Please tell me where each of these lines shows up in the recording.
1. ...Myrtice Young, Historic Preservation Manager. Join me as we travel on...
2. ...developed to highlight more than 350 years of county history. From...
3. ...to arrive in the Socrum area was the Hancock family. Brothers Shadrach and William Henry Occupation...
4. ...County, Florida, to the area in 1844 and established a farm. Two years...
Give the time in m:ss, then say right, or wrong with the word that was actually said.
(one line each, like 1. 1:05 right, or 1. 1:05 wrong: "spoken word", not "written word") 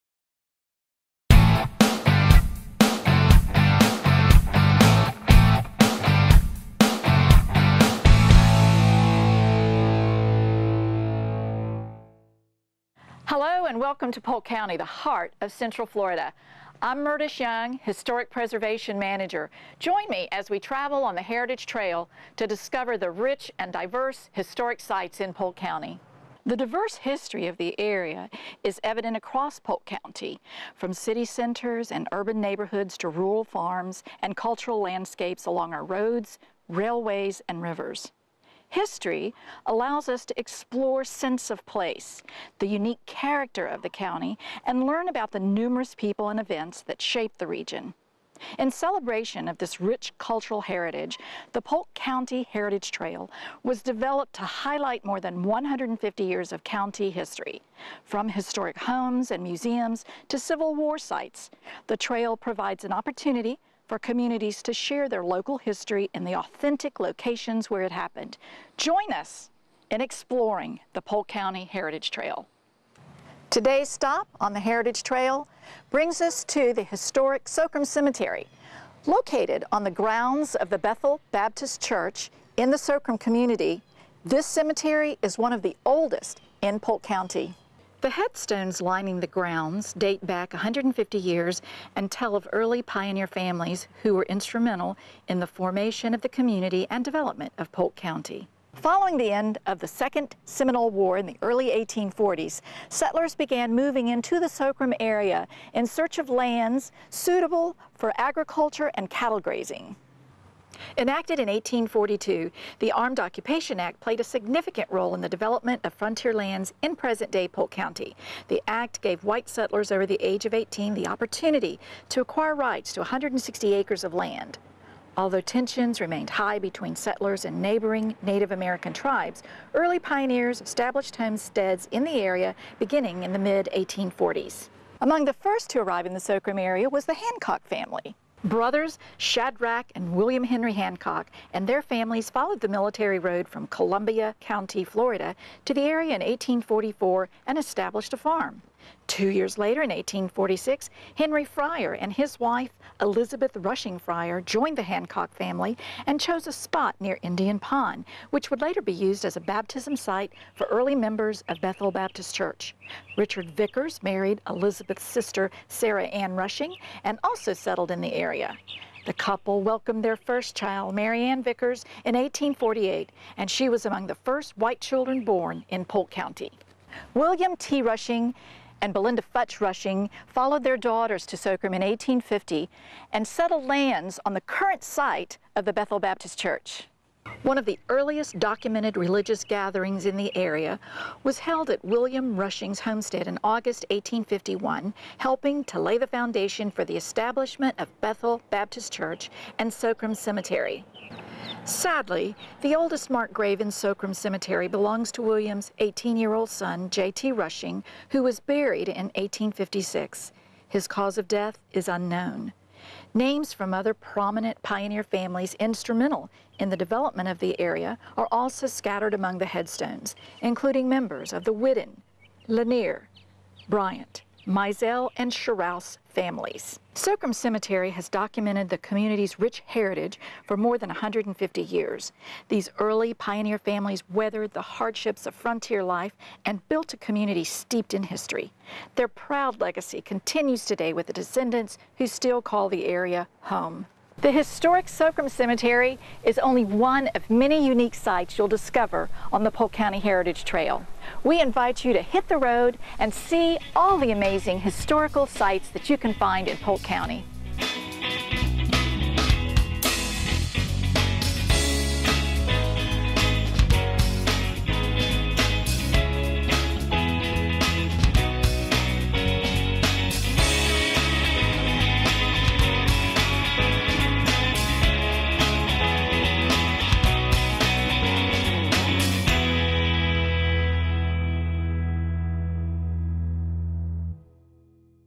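1. 0:17 right
2. 0:53 wrong: "150", not "350"
3. 2:15 wrong: "Hancock", not "Occupation"
4. 2:24 right.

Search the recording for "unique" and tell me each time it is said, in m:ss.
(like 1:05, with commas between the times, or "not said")
0:42, 4:07.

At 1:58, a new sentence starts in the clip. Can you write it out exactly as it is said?
The act gave white settlers over the age of 18 the opportunity to acquire rights to 160 acres of land.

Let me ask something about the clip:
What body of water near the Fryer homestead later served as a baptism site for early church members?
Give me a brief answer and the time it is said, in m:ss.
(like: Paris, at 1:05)
Indian Pond, at 2:37.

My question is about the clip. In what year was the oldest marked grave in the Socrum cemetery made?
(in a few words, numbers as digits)
1856.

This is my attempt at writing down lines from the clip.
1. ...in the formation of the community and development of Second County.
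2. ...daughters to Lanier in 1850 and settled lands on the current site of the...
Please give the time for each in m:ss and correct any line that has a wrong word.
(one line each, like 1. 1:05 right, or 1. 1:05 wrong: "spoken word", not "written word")
1. 1:35 wrong: "Polk", not "Second"
2. 3:00 wrong: "Socrum", not "Lanier".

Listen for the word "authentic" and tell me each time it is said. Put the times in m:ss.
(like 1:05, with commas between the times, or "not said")
1:06.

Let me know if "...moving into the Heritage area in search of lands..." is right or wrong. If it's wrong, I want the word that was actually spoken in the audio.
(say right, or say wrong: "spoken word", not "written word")
wrong: "Socrum", not "Heritage".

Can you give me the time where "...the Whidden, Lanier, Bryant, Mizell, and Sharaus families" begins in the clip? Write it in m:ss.
3:41.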